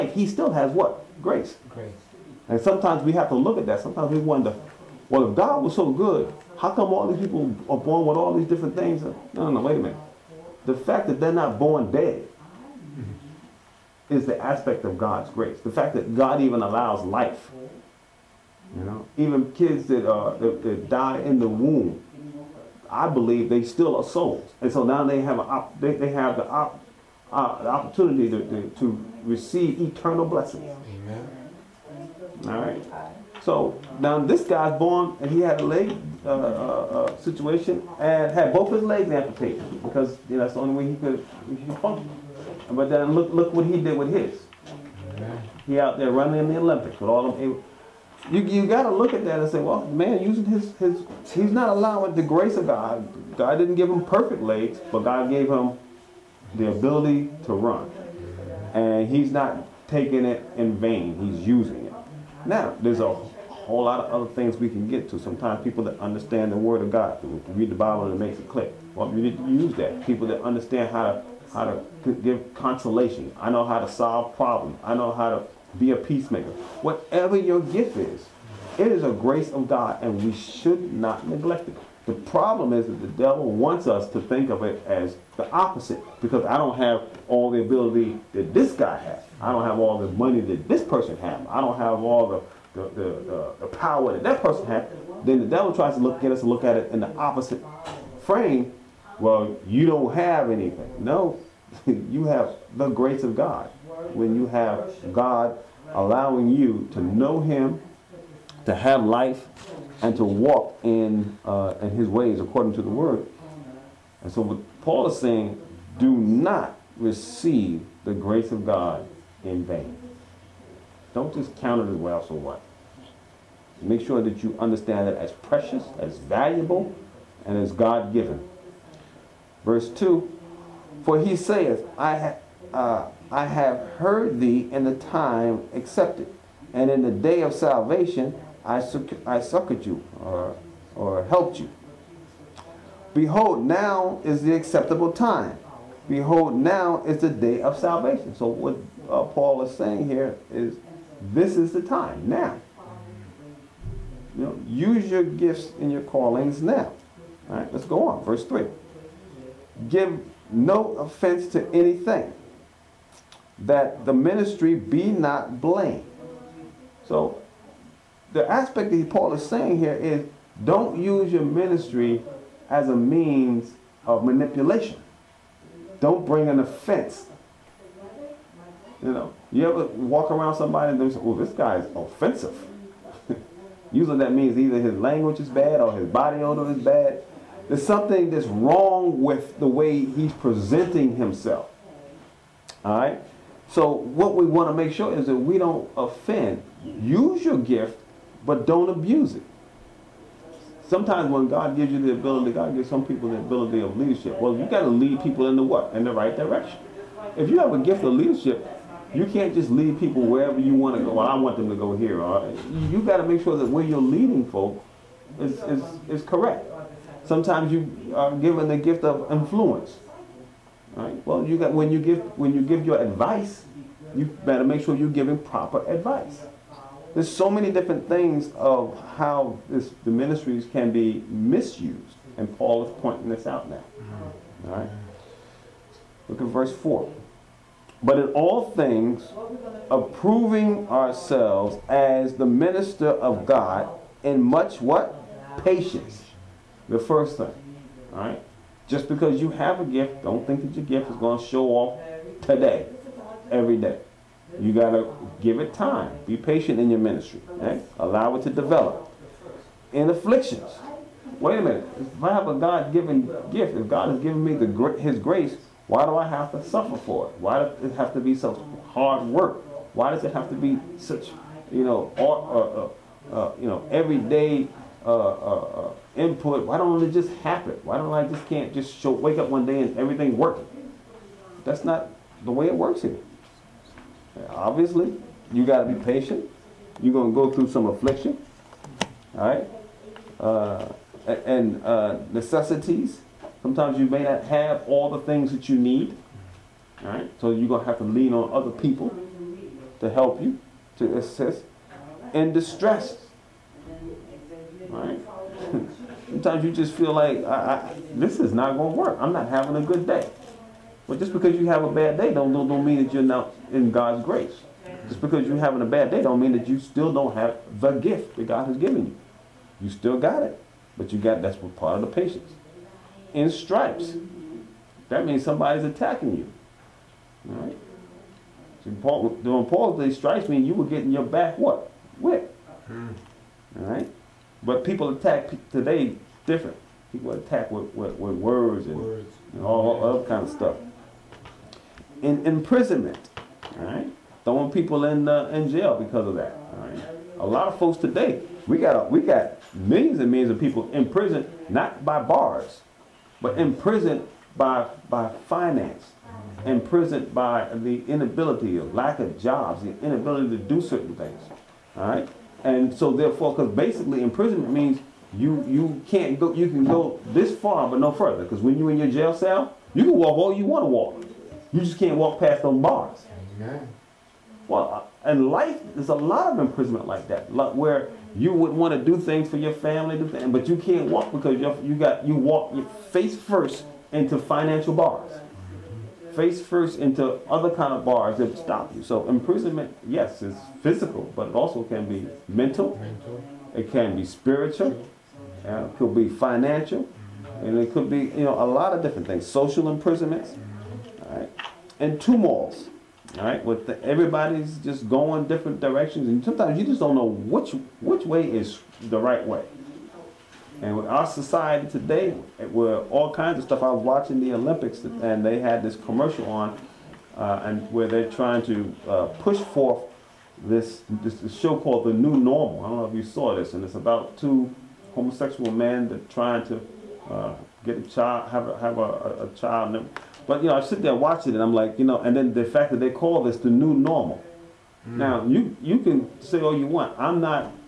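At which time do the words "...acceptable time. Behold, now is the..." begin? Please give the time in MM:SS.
02:24.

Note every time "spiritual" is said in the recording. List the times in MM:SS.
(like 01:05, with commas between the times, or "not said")
06:34.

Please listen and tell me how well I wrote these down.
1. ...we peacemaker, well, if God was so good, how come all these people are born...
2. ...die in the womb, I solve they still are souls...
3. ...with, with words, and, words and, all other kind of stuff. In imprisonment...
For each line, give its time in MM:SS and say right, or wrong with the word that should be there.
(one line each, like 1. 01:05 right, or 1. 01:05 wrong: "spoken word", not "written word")
1. 00:04 wrong: "wonder", not "peacemaker"
2. 00:20 wrong: "believe", not "solve"
3. 05:37 right.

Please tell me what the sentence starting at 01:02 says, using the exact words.
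Now there's a whole lot of other things we can get to.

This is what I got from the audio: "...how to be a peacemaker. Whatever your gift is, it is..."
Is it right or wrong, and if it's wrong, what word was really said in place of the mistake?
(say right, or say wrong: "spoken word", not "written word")
right.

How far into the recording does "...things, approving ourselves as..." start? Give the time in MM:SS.
03:58.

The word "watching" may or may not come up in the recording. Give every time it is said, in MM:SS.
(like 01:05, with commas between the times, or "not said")
06:54, 07:11.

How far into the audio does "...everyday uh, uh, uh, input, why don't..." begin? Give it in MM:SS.
04:33.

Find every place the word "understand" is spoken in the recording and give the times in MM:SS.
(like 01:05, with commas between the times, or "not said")
01:05, 01:10, 02:04.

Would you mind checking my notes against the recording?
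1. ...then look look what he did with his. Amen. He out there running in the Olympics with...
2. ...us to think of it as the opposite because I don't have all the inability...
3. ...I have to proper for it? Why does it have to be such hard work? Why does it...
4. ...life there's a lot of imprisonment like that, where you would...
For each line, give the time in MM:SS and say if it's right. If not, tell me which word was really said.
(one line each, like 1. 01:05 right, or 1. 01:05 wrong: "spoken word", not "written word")
1. 00:42 right
2. 01:23 wrong: "ability", not "inability"
3. 04:26 wrong: "suffer", not "proper"
4. 06:15 right.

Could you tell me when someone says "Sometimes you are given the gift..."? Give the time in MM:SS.
03:37.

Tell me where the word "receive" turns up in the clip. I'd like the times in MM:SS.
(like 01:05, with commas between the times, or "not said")
00:29, 01:56.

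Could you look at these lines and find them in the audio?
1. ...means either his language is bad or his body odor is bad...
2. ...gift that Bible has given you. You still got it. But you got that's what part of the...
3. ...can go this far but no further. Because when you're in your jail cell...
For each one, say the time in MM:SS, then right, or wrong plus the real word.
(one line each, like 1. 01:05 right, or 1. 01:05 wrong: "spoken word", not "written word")
1. 03:04 right
2. 05:17 wrong: "God", not "Bible"
3. 06:06 right.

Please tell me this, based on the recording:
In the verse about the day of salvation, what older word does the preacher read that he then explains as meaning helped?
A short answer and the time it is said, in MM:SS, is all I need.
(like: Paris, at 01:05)
Succored, at 02:19.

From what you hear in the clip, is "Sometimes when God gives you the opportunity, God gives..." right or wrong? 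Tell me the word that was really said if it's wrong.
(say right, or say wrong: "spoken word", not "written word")
wrong: "ability", not "opportunity".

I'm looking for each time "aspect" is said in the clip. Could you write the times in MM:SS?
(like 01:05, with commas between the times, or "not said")
00:14, 02:48.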